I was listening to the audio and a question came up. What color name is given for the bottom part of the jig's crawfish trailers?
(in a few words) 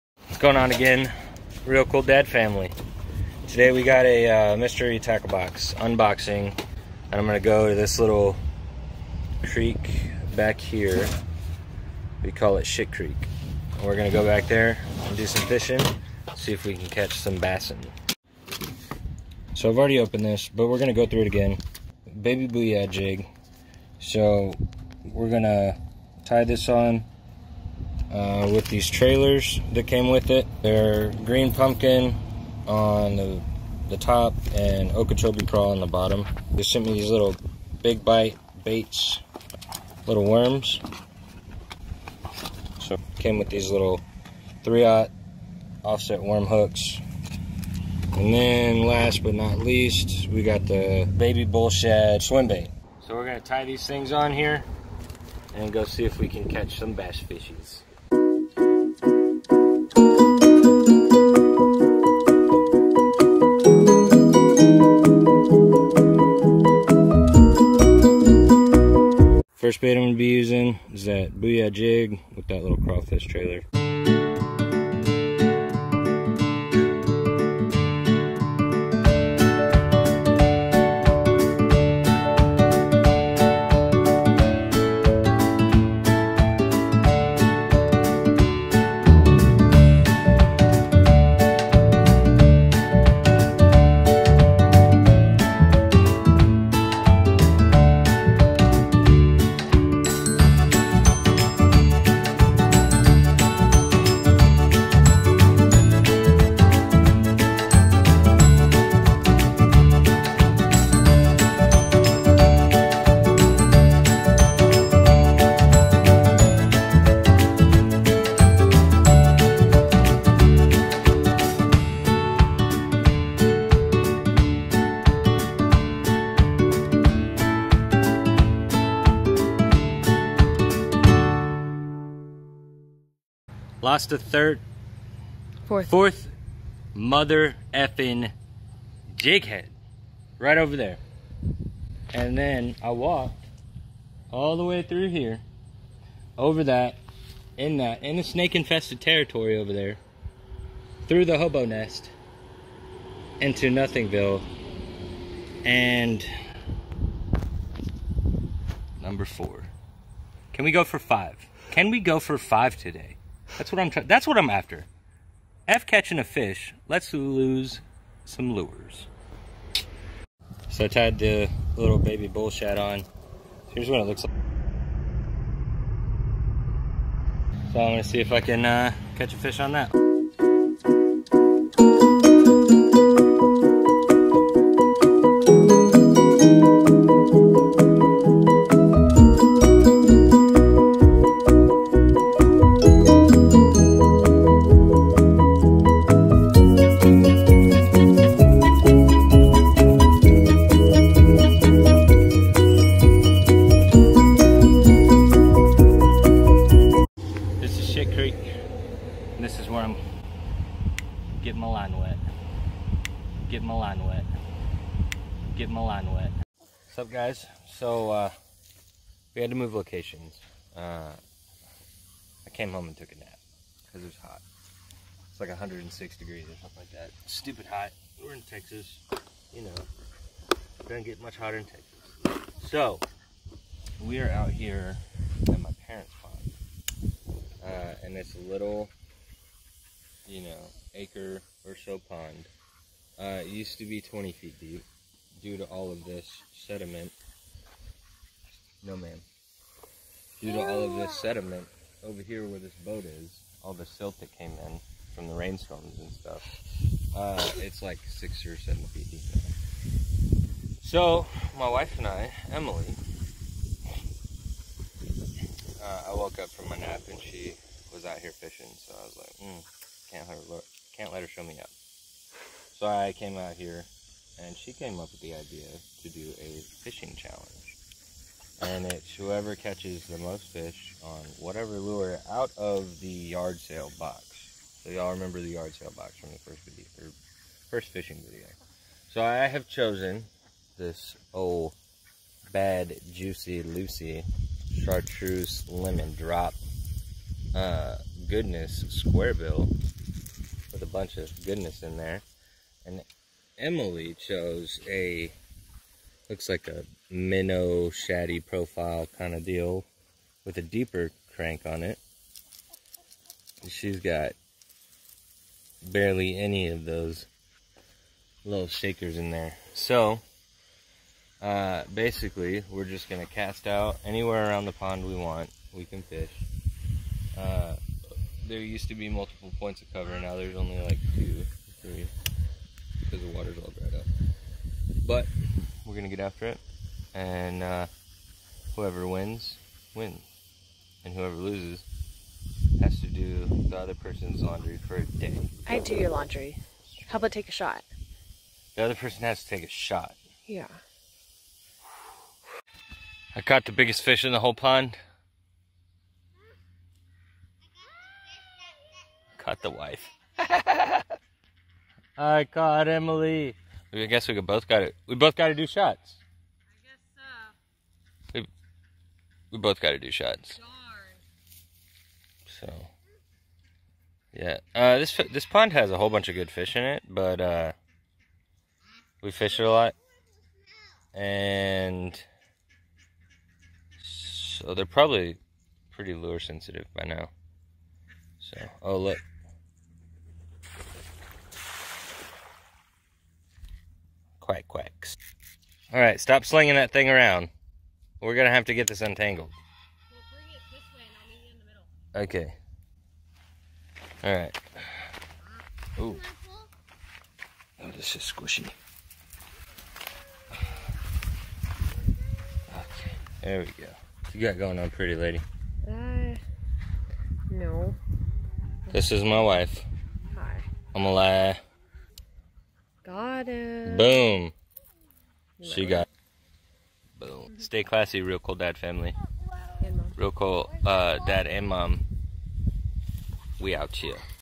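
Okeechobee crawl.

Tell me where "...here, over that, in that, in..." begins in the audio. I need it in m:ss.
2:25.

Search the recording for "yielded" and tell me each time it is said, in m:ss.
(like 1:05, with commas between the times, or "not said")
not said.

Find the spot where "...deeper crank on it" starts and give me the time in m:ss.
5:10.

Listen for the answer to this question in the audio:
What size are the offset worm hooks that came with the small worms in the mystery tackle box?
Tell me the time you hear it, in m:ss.
0:44.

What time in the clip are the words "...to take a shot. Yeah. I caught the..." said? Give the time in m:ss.
5:49.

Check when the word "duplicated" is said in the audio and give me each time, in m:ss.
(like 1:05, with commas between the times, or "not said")
not said.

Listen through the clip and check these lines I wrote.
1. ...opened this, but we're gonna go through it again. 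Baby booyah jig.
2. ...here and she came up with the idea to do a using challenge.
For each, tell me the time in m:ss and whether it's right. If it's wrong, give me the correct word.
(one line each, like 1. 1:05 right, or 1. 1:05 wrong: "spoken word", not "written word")
1. 0:19 right
2. 4:33 wrong: "fishing", not "using".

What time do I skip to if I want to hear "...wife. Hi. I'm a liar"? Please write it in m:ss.
6:59.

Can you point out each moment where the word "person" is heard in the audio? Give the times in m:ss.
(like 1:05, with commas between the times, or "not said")
5:43, 5:48.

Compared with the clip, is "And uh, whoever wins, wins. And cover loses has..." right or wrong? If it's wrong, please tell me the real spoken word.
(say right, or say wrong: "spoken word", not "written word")
wrong: "whoever", not "cover".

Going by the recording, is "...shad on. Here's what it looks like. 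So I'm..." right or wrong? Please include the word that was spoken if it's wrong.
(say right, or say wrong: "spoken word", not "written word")
right.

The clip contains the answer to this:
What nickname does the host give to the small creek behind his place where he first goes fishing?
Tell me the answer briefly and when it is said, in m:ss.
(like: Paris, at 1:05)
Shit Creek, at 0:12.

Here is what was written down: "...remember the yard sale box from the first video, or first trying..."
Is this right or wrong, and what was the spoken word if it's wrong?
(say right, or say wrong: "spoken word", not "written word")
wrong: "fishing", not "trying".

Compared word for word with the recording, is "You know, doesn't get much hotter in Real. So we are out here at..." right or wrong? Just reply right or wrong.
wrong.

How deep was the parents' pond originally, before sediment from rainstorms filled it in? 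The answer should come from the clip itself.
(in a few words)
20 feet.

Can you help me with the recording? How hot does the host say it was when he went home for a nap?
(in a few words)
106 degrees.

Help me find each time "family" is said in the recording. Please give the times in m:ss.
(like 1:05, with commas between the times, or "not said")
0:02, 7:08.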